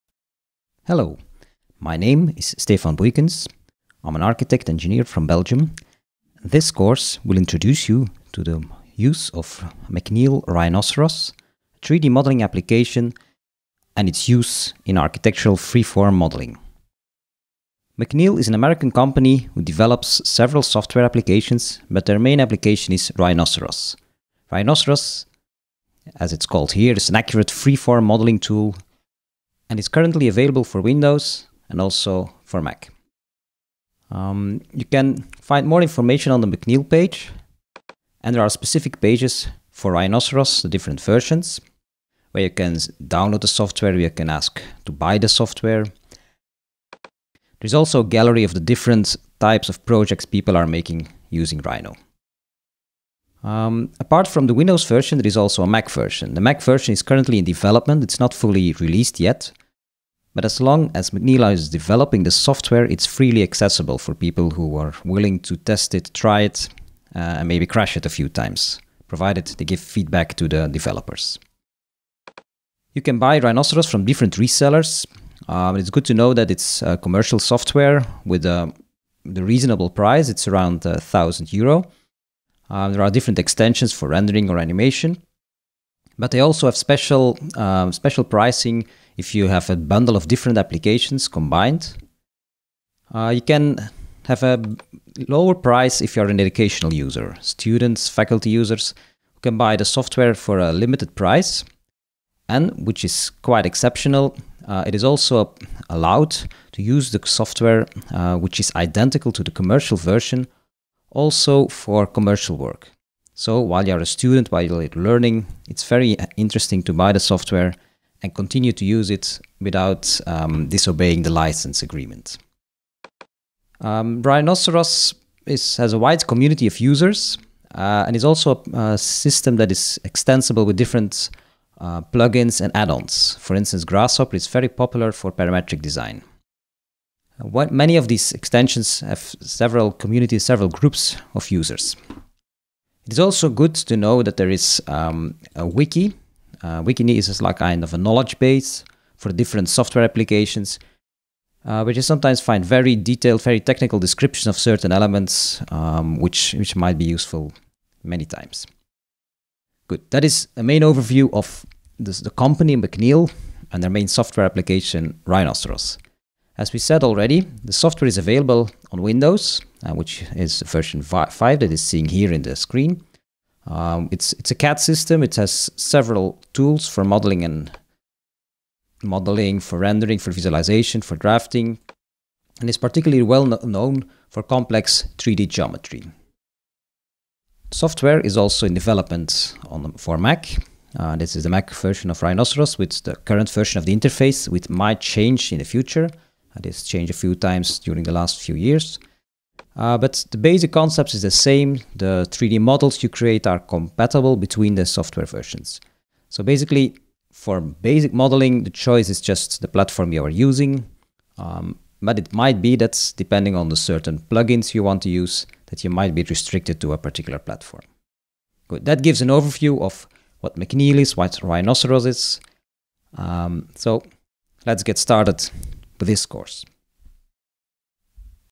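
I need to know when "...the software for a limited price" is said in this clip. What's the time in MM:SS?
01:39.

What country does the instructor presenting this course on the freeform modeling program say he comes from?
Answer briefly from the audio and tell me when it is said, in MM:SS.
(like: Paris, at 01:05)
Belgium, at 00:05.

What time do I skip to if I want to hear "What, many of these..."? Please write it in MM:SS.
02:17.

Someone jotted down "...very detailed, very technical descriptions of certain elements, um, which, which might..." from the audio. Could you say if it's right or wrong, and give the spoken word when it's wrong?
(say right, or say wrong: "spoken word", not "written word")
right.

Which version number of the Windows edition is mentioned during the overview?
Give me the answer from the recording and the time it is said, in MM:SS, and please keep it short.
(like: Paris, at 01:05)
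5, at 02:50.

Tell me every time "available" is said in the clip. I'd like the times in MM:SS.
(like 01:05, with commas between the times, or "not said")
00:30, 02:48.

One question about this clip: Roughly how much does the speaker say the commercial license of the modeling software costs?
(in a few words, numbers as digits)
1,000 euro.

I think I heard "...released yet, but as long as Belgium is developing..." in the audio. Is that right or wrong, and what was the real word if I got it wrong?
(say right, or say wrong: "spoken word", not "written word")
wrong: "McNeila", not "Belgium".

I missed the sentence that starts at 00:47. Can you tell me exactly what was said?
There's also a gallery of the different types of projects people are making using Rhino.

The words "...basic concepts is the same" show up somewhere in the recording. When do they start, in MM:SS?
03:20.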